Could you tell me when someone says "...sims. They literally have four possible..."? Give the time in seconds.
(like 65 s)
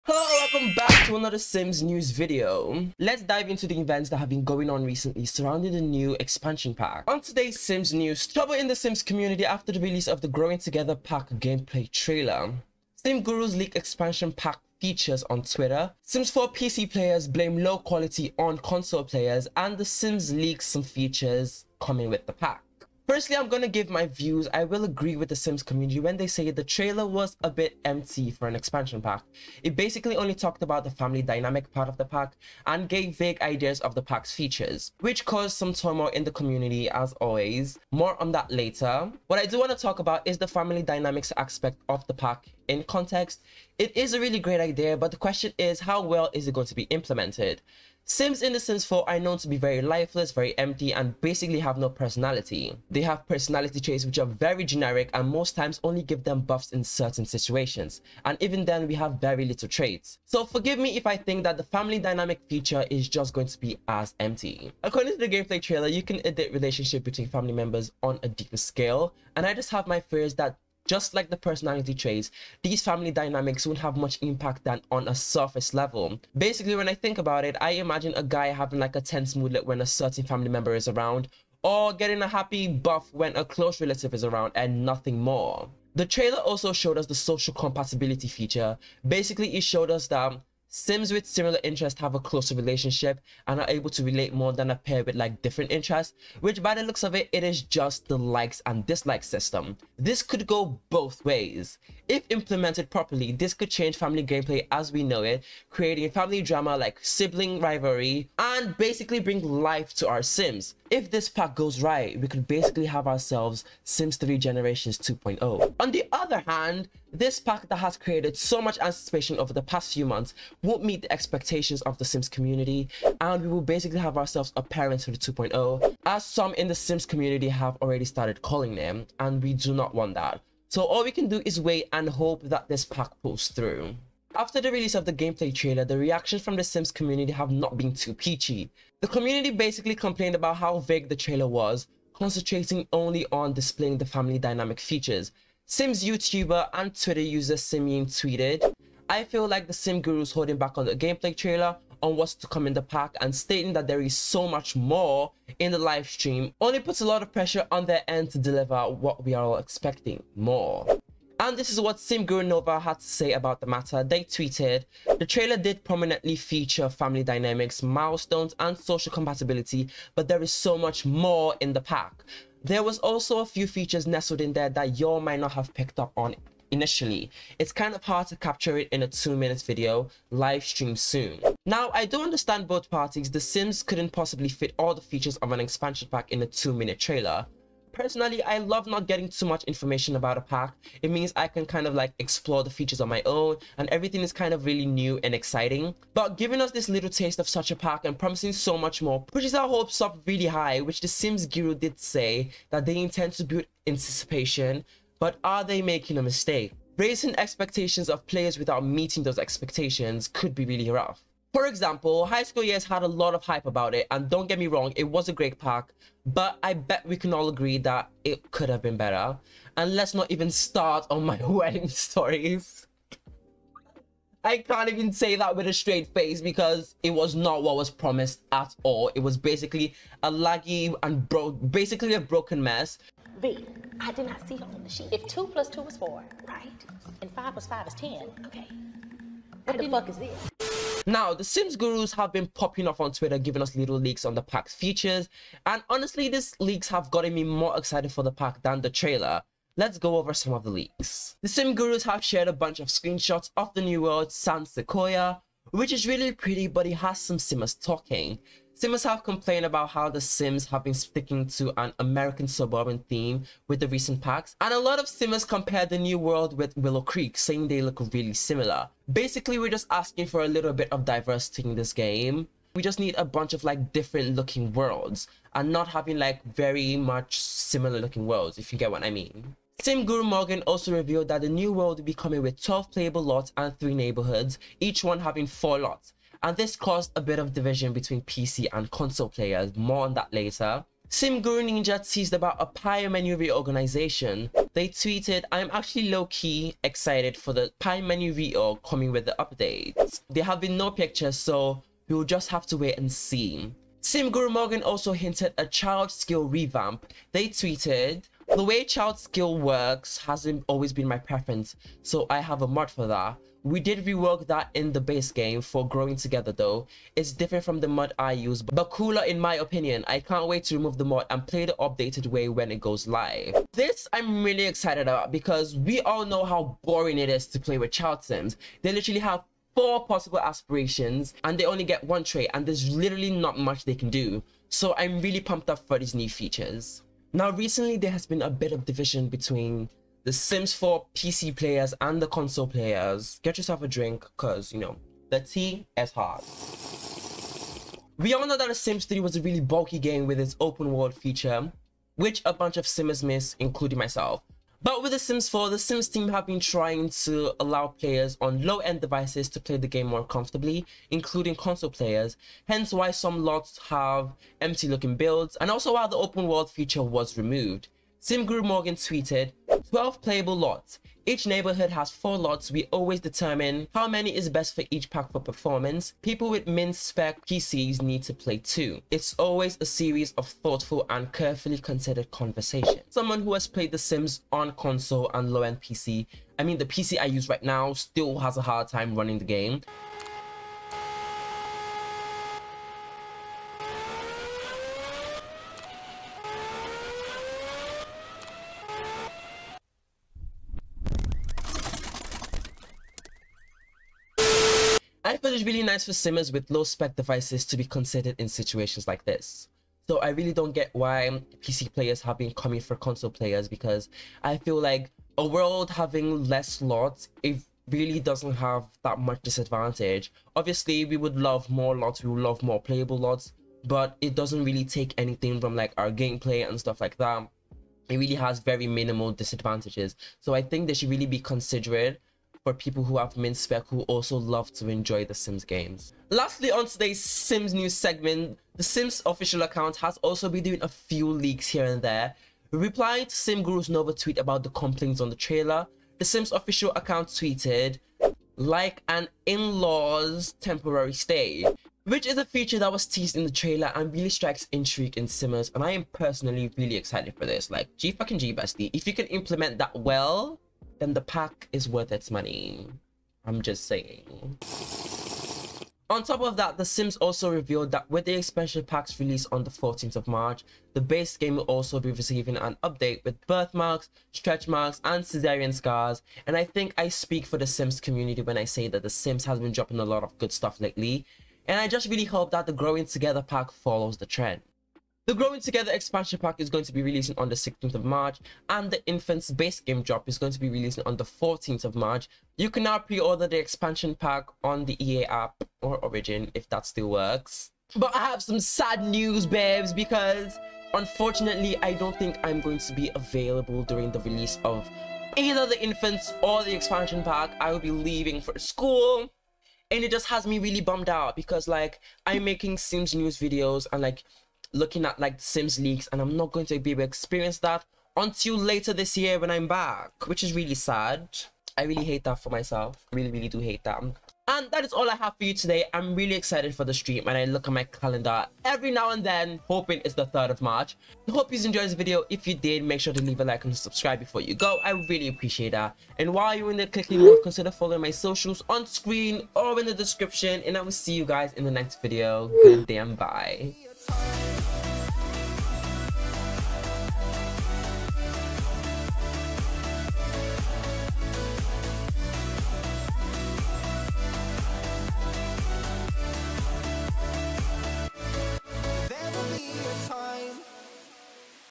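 328 s.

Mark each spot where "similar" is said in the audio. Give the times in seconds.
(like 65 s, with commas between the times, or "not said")
91 s, 268 s, 277 s.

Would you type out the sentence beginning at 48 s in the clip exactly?
Sims in The Sims 4 are known to be very lifeless, very empty, and basically have no personality.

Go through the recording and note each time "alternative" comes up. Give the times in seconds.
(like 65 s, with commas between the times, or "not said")
not said.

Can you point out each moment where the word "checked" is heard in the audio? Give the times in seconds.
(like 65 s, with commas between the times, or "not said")
not said.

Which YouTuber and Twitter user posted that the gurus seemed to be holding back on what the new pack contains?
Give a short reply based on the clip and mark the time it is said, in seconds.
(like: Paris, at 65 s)
Simeon, at 147 s.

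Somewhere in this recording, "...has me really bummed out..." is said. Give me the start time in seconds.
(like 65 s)
510 s.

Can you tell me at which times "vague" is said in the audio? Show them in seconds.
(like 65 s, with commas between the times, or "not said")
33 s, 140 s.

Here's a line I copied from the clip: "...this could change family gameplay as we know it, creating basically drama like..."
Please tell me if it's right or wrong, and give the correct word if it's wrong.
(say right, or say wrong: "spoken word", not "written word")
wrong: "family", not "basically".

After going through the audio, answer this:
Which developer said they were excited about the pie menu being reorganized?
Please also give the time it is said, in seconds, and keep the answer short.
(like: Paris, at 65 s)
Sim Guru Ninja, at 291 s.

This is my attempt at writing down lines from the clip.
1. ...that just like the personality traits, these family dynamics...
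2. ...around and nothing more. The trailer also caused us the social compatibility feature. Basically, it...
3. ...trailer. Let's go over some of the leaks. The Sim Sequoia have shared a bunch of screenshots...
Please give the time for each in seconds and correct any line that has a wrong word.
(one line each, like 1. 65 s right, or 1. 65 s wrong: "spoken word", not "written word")
1. 70 s right
2. 84 s wrong: "showed", not "caused"
3. 248 s wrong: "Gurus", not "Sequoia".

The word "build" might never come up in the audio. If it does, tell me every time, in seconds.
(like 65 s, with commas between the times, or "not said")
203 s, 365 s.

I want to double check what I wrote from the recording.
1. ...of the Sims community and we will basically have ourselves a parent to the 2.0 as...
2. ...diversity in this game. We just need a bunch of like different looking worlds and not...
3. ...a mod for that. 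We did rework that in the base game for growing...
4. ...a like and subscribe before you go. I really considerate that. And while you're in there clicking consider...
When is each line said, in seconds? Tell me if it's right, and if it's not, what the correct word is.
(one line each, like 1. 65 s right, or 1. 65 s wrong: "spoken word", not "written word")
1. 121 s right
2. 271 s right
3. 312 s right
4. 533 s wrong: "appreciate", not "considerate".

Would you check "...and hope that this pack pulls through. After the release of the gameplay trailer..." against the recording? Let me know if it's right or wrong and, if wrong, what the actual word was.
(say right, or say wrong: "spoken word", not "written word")
right.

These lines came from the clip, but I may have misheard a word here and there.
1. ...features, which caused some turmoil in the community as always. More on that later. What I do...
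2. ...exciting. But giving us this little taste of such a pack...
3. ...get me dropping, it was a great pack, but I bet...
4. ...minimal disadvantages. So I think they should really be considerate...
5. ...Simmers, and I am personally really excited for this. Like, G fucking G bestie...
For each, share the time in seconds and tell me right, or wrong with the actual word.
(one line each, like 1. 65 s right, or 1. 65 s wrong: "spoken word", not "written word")
1. 34 s right
2. 195 s right
3. 214 s wrong: "wrong", not "dropping"
4. 428 s right
5. 455 s right.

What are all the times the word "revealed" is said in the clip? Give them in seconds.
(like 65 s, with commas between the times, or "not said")
280 s, 467 s.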